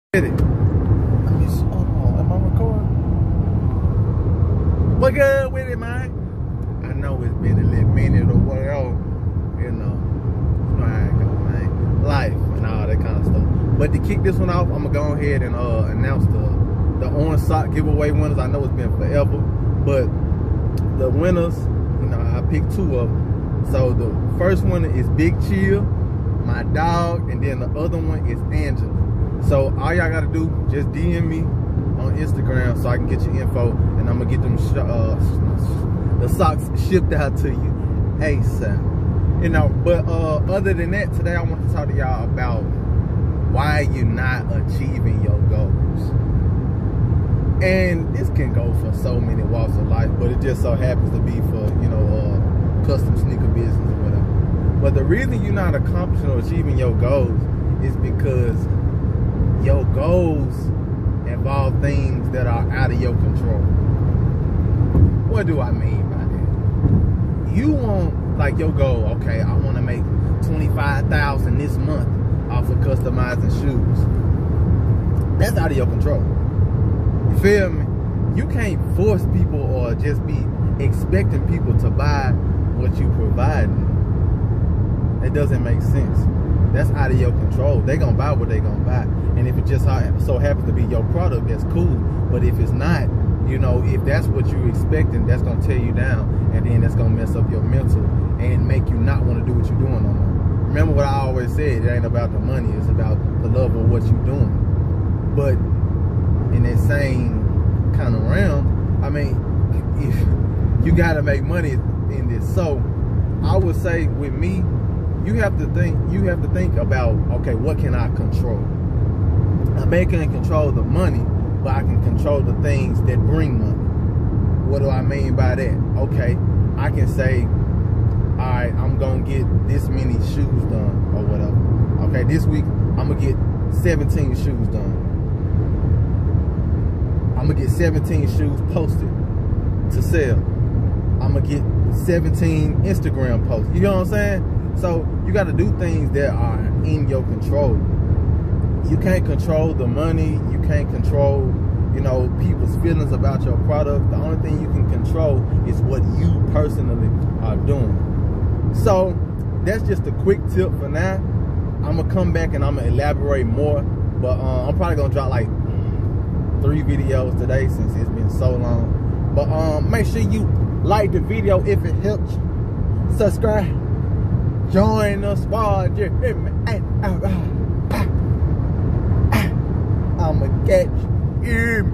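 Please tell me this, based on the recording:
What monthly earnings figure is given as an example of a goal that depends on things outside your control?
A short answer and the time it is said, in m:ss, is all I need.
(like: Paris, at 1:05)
25,000, at 1:10.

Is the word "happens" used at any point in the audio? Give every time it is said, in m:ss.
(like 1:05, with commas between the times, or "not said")
0:50, 1:30.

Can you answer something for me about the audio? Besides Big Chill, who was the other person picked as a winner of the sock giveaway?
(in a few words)
Angela.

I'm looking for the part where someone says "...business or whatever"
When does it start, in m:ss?
0:53.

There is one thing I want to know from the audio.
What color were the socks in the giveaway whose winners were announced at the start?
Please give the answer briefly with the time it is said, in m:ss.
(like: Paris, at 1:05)
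Orange, at 0:17.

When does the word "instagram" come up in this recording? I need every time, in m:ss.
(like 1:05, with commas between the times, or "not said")
0:32, 2:22.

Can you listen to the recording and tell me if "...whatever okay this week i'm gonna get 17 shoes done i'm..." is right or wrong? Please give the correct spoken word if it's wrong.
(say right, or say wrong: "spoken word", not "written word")
right.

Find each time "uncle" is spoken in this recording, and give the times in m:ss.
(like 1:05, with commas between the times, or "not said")
not said.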